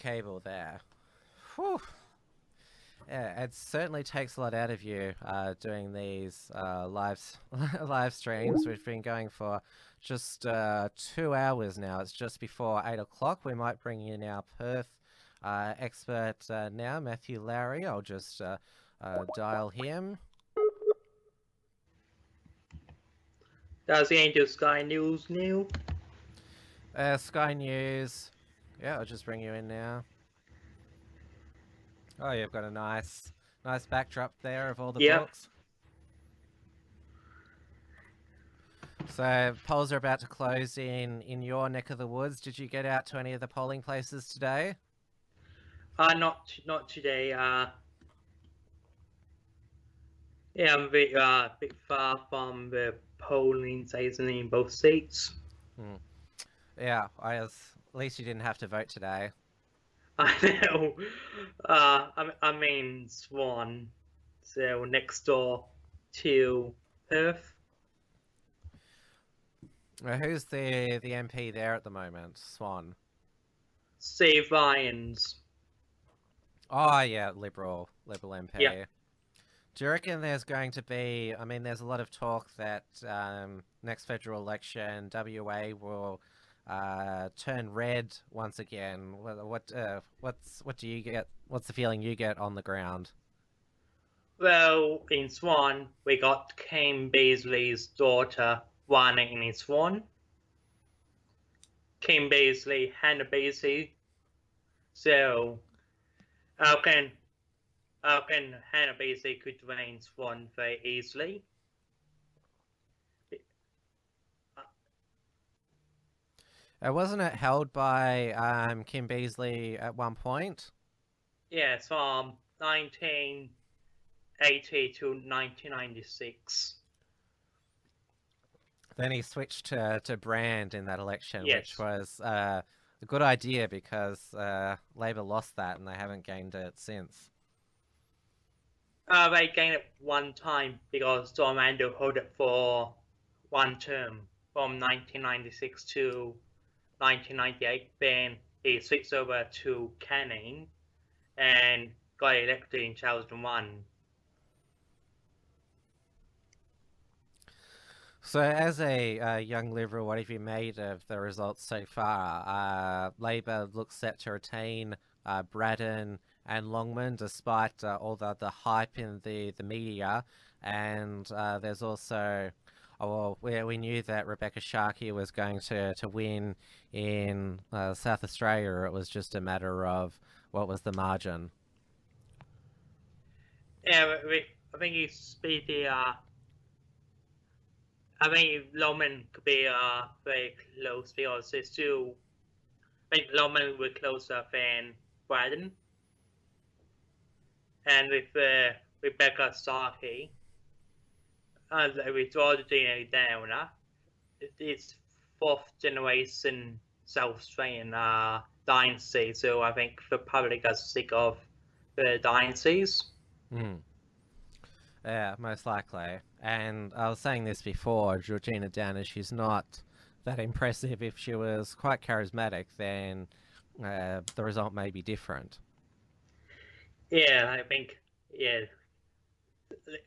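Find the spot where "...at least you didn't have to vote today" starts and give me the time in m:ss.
0:57.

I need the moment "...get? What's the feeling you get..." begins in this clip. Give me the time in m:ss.
1:31.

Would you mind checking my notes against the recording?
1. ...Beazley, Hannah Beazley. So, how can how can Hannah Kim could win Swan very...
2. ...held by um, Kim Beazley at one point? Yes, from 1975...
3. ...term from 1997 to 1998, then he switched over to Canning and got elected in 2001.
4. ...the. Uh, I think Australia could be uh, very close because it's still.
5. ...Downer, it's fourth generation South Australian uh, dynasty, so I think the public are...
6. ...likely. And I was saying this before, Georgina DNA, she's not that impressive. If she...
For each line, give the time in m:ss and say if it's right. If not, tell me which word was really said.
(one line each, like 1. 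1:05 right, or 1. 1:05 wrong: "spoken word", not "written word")
1. 1:42 wrong: "Beazley", not "Kim"
2. 1:57 wrong: "1980", not "1975"
3. 2:23 wrong: "1996", not "1997"
4. 3:05 wrong: "Longman", not "Australia"
5. 3:23 right
6. 3:35 wrong: "Downer", not "DNA".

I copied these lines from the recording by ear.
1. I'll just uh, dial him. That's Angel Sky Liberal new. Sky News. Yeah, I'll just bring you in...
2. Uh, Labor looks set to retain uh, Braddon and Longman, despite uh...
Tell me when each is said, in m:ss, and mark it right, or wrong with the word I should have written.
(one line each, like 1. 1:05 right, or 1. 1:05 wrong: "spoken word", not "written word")
1. 0:17 wrong: "News", not "Liberal"
2. 2:43 right.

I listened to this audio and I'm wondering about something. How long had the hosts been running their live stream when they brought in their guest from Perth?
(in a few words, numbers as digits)
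2 hours.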